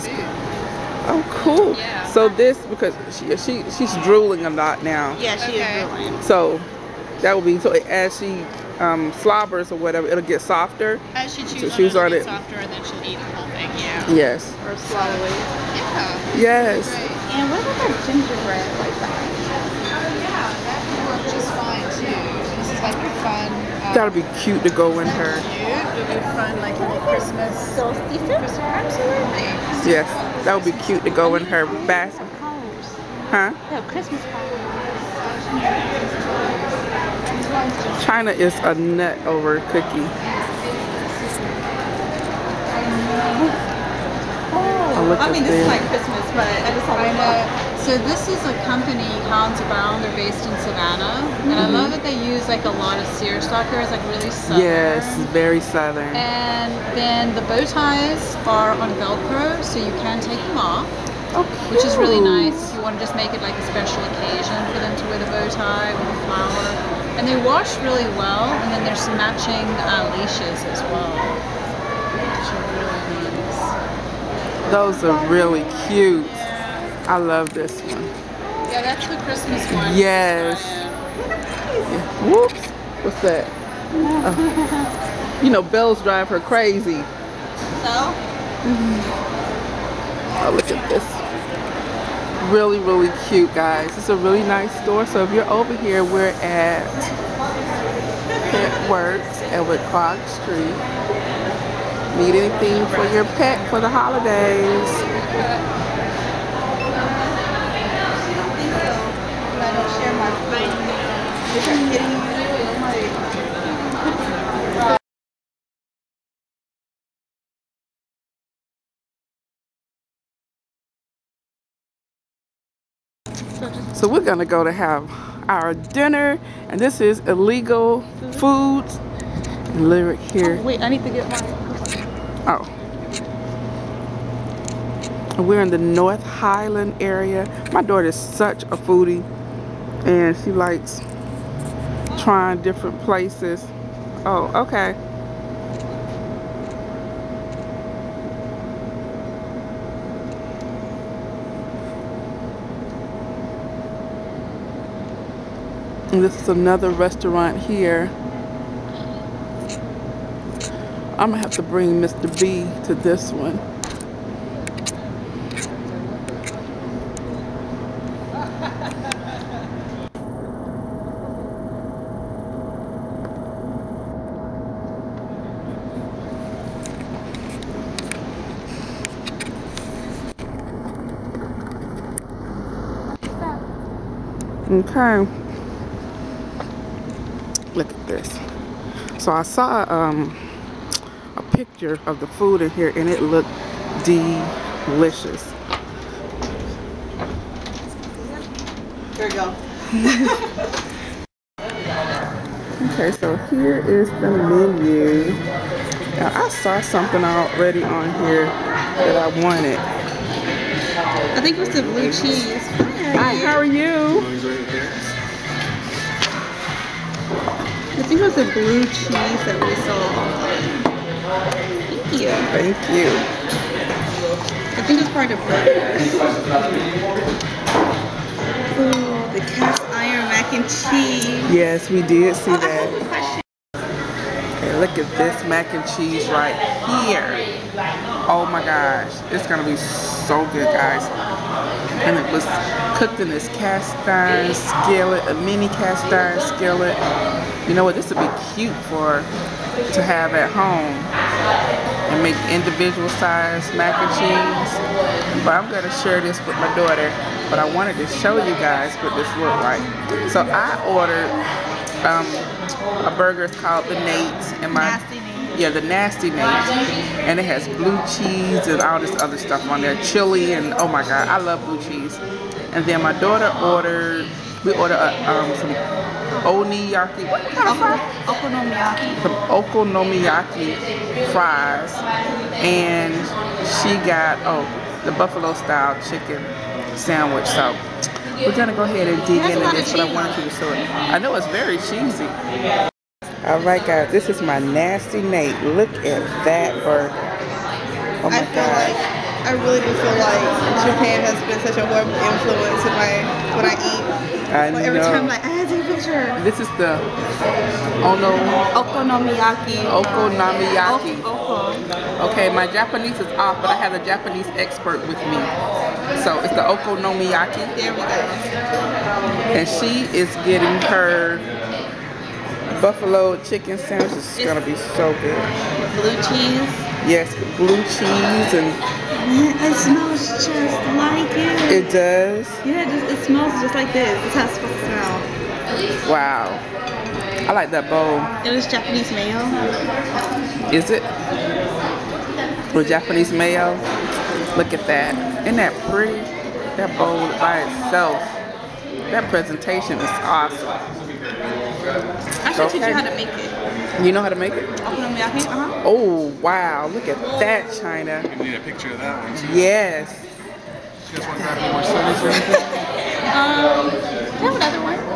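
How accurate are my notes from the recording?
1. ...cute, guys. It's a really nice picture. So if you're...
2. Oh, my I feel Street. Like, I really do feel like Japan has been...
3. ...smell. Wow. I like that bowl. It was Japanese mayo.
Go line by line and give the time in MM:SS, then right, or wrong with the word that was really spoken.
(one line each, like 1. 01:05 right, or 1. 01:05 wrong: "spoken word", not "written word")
1. 01:33 wrong: "store", not "picture"
2. 04:58 wrong: "God", not "Street"
3. 05:34 right.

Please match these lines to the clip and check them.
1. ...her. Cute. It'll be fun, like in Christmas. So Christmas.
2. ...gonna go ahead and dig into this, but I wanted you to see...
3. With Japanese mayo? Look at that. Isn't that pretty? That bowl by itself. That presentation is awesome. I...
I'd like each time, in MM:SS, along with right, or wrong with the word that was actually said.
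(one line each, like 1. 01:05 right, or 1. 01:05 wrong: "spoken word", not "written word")
1. 00:25 right
2. 04:48 right
3. 05:42 right.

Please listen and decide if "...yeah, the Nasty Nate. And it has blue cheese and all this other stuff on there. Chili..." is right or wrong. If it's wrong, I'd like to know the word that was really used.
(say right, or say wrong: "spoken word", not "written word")
right.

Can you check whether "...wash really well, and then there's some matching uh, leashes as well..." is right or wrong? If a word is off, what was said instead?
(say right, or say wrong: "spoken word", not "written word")
right.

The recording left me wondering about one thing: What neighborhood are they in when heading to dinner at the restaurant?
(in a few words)
North Highland.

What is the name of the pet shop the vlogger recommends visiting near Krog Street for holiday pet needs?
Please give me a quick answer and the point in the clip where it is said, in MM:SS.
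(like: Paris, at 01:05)
Pet Works, at 01:38.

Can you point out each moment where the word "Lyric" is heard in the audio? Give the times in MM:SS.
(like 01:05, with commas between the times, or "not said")
02:09.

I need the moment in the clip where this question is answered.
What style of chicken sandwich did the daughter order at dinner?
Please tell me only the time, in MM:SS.
04:45.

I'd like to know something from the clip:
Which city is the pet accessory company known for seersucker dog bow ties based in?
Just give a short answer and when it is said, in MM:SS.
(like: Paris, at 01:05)
Savannah, at 00:50.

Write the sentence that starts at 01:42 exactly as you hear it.
Need anything for your pet for the holidays?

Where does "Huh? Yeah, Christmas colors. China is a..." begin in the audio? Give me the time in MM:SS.
00:33.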